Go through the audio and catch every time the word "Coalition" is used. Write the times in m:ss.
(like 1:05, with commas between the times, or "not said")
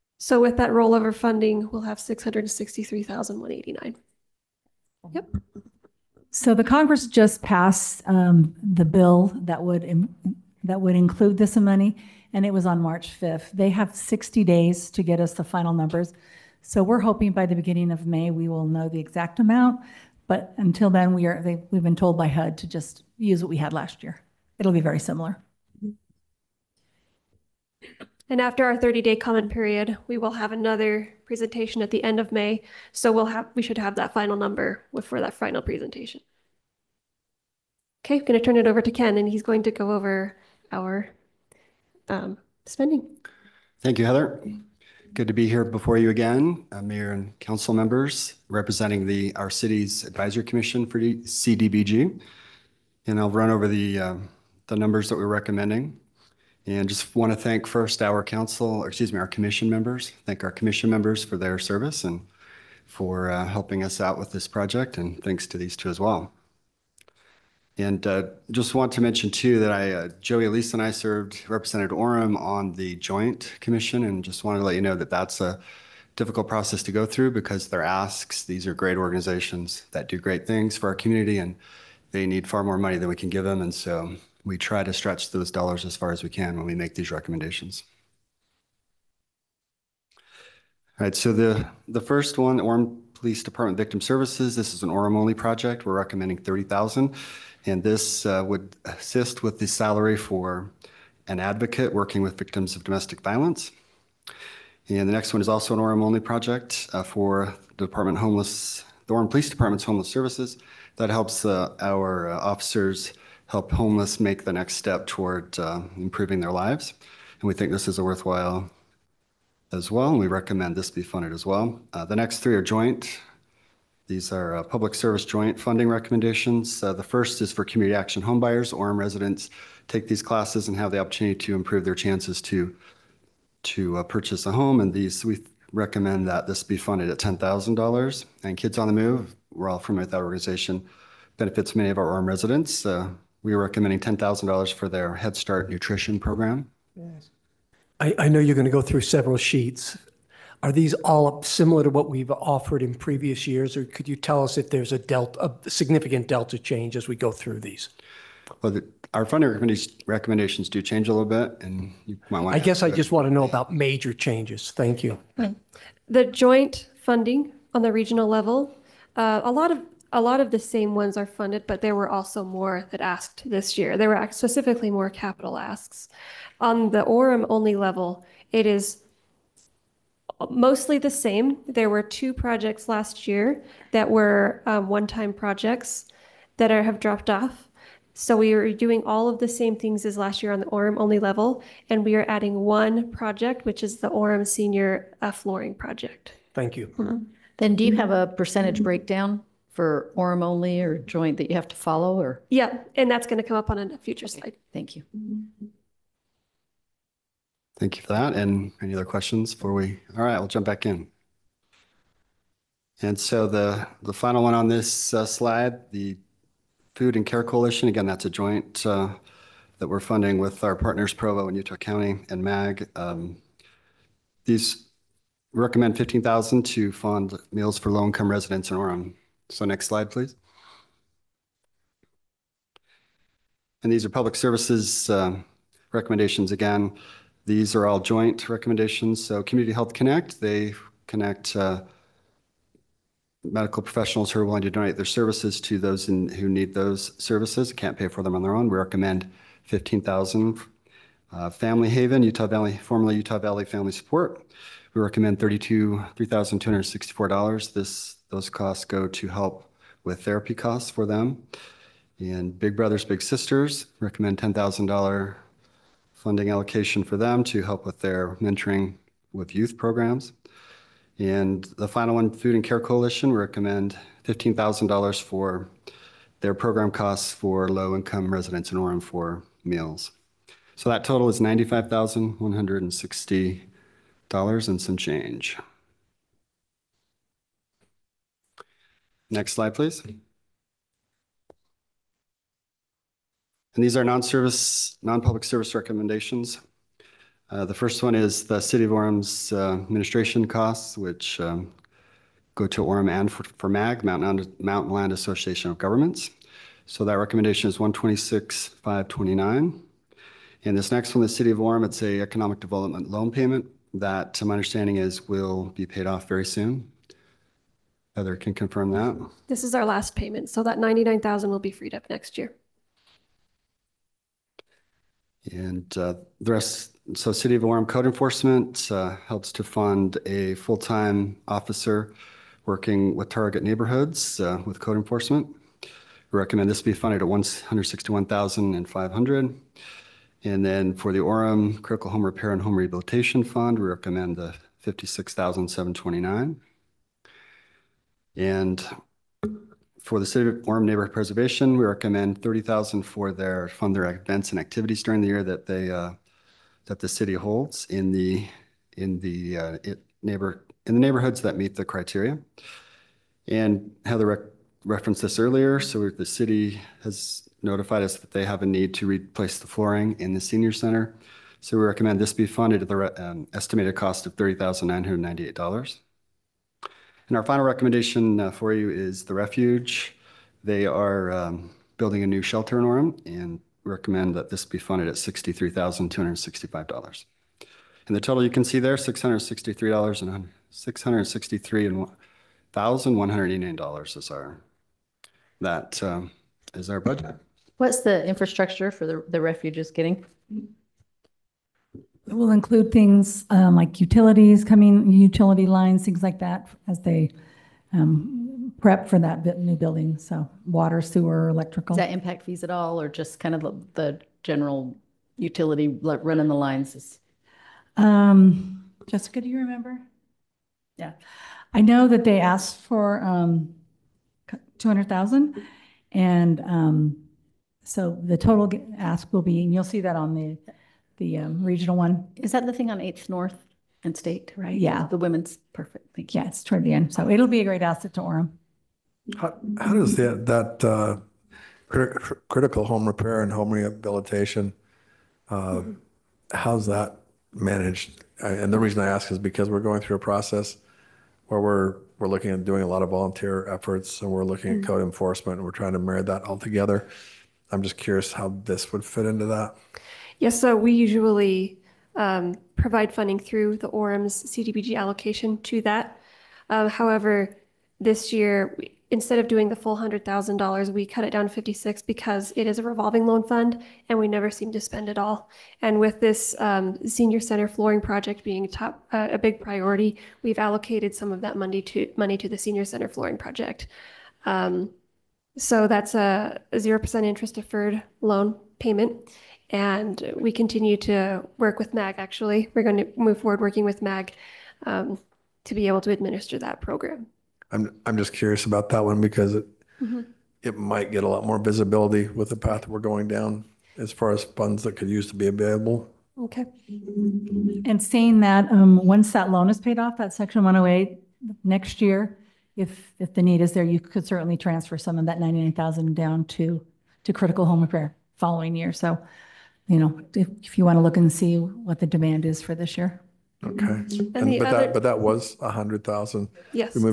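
3:37, 4:32.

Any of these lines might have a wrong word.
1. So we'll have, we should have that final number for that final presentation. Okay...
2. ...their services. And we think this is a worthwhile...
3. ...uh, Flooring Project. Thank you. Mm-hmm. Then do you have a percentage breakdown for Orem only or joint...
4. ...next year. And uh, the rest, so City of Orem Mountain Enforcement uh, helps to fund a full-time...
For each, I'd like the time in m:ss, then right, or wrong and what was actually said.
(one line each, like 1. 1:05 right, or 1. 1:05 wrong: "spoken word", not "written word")
1. 0:32 right
2. 1:56 wrong: "lives", not "services"
3. 3:15 right
4. 5:22 wrong: "Code", not "Mountain".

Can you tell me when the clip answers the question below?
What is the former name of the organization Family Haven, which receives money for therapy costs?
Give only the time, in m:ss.
4:13.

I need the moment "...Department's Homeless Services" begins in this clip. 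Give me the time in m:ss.
1:49.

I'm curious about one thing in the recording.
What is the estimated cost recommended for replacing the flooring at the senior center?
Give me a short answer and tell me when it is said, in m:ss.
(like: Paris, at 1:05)
$30,998, at 6:14.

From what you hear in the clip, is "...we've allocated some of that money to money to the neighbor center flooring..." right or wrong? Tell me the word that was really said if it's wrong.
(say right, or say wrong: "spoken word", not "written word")
wrong: "senior", not "neighbor".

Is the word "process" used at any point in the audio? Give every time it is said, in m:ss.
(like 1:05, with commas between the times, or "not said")
1:16, 7:30.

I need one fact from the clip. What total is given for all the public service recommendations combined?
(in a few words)
$95,160.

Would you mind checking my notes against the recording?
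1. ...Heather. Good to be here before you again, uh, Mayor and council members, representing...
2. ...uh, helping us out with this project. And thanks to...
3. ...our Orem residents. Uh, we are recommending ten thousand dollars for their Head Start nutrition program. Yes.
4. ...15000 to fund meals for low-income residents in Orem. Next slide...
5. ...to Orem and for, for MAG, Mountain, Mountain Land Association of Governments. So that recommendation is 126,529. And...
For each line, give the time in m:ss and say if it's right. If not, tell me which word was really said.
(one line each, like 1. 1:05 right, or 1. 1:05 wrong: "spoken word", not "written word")
1. 0:44 right
2. 1:03 right
3. 2:21 right
4. 3:45 right
5. 5:02 right.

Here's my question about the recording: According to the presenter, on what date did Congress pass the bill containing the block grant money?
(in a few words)
March 5th.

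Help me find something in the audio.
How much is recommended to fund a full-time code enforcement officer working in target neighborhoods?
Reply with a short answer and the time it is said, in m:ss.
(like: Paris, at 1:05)
161,500, at 5:37.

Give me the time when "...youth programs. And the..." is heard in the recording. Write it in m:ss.
4:29.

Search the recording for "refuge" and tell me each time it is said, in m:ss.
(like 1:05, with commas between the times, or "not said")
6:19, 6:39.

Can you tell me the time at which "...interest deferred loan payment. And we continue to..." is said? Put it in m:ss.
8:07.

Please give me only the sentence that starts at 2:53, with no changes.
There were specifically more capital asks.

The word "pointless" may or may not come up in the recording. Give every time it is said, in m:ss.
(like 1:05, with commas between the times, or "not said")
not said.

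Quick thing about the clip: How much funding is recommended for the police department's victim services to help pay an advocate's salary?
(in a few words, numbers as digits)
30,000.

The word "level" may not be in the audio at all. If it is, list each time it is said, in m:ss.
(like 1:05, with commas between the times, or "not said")
2:48, 2:57, 3:11.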